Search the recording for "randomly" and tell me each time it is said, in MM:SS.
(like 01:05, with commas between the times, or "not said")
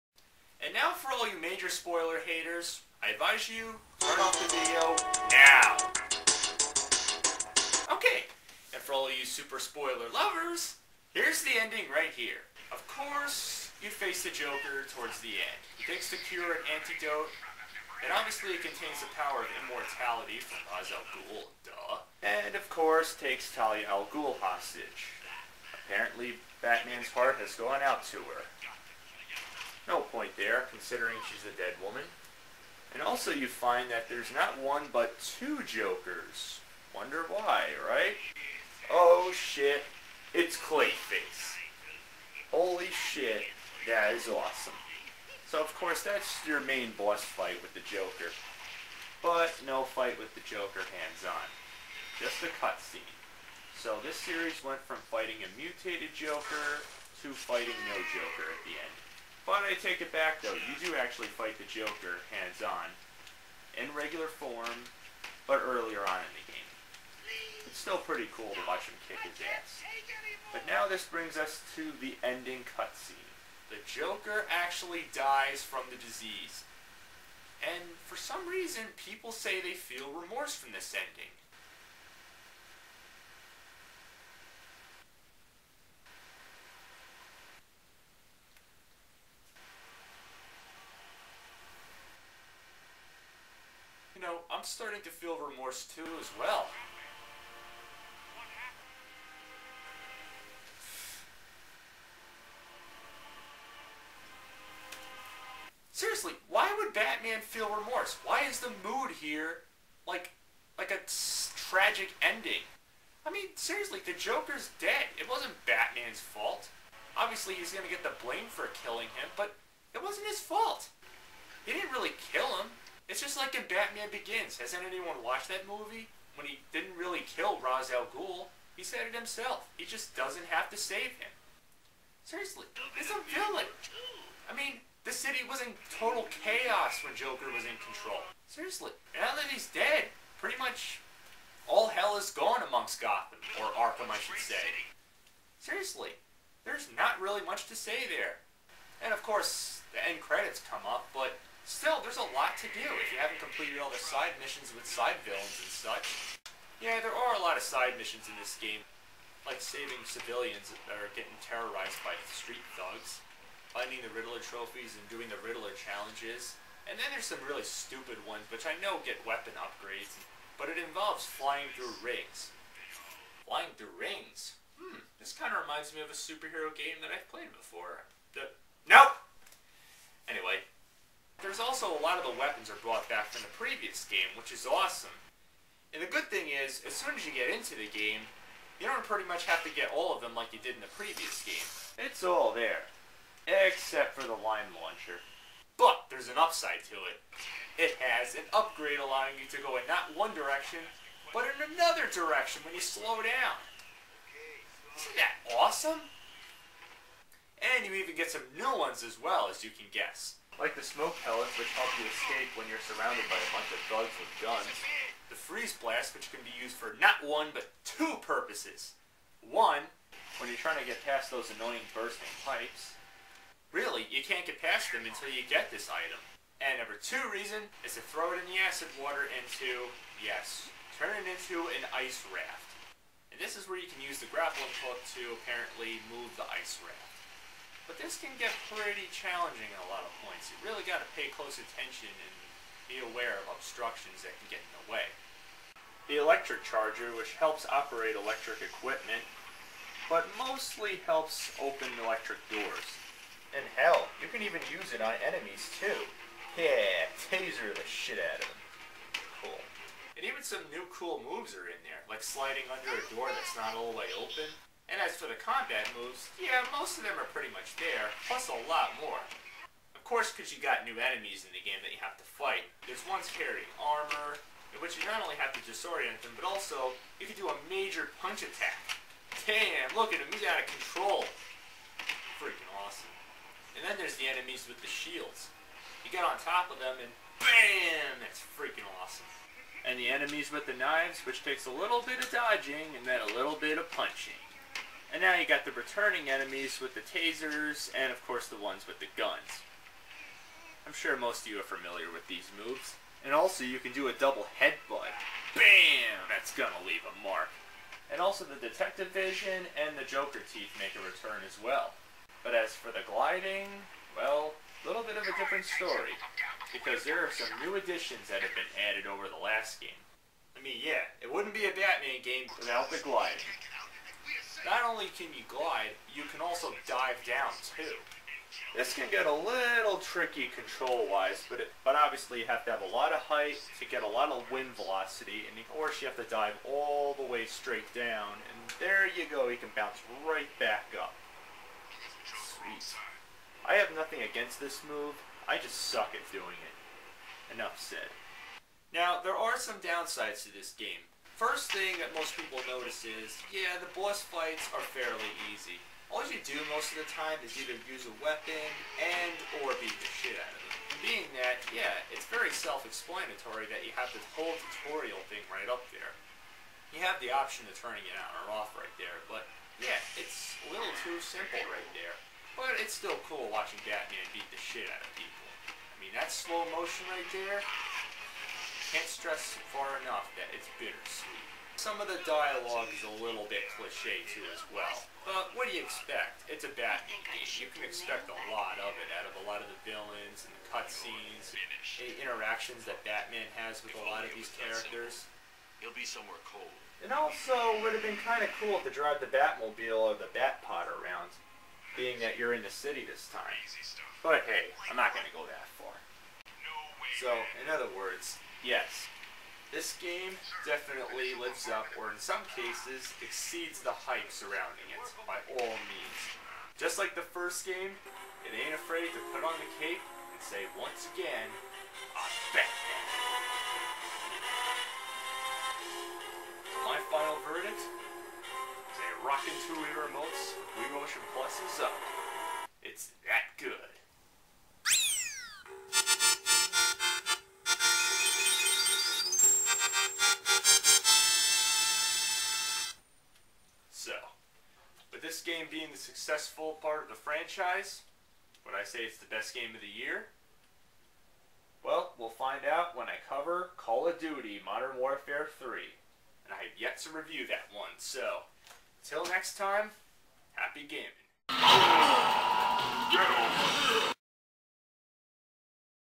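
not said.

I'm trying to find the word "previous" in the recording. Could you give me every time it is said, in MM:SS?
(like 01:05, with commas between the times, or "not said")
03:03, 03:10.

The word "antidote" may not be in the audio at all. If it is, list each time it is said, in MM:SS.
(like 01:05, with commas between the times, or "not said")
00:16.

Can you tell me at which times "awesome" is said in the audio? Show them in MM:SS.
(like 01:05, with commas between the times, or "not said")
00:44, 03:04, 03:25, 04:42, 04:48.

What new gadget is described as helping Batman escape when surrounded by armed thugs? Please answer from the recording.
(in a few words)
smoke pellets.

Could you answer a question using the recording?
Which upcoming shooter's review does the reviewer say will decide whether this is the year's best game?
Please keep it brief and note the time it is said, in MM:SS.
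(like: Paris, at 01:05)
Call of Duty Modern Warfare 3, at 07:33.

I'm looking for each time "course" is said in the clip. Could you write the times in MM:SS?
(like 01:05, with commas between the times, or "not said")
00:12, 00:22, 00:45, 02:29, 04:30, 04:58, 05:35.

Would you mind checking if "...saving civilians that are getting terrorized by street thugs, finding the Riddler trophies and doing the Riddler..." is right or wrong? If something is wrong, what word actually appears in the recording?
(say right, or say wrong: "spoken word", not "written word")
right.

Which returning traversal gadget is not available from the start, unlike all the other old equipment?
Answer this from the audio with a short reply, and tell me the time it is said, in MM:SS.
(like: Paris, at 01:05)
line launcher, at 03:14.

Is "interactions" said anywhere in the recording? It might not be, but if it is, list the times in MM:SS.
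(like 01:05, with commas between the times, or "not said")
06:32.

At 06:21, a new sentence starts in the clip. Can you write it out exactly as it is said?
Some of the dialogue is a little bit cliche too as well.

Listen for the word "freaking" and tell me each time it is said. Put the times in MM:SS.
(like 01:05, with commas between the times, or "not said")
04:42, 04:48.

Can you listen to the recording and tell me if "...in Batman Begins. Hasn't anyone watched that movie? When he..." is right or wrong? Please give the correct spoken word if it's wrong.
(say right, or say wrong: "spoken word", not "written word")
right.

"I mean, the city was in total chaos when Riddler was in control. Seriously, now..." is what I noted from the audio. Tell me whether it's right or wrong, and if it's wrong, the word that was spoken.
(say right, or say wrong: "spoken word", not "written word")
wrong: "Joker", not "Riddler".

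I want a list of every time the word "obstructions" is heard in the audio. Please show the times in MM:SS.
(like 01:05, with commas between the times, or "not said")
04:03.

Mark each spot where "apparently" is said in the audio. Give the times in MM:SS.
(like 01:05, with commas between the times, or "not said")
00:25, 03:55.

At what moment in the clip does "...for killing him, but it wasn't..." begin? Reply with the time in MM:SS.
01:58.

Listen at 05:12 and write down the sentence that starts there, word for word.
But as for the gliding, well, a little bit of a different story.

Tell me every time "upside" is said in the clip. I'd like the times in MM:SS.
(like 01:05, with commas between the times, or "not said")
03:16.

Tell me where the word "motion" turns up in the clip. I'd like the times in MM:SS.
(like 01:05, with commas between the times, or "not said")
06:16, 07:10.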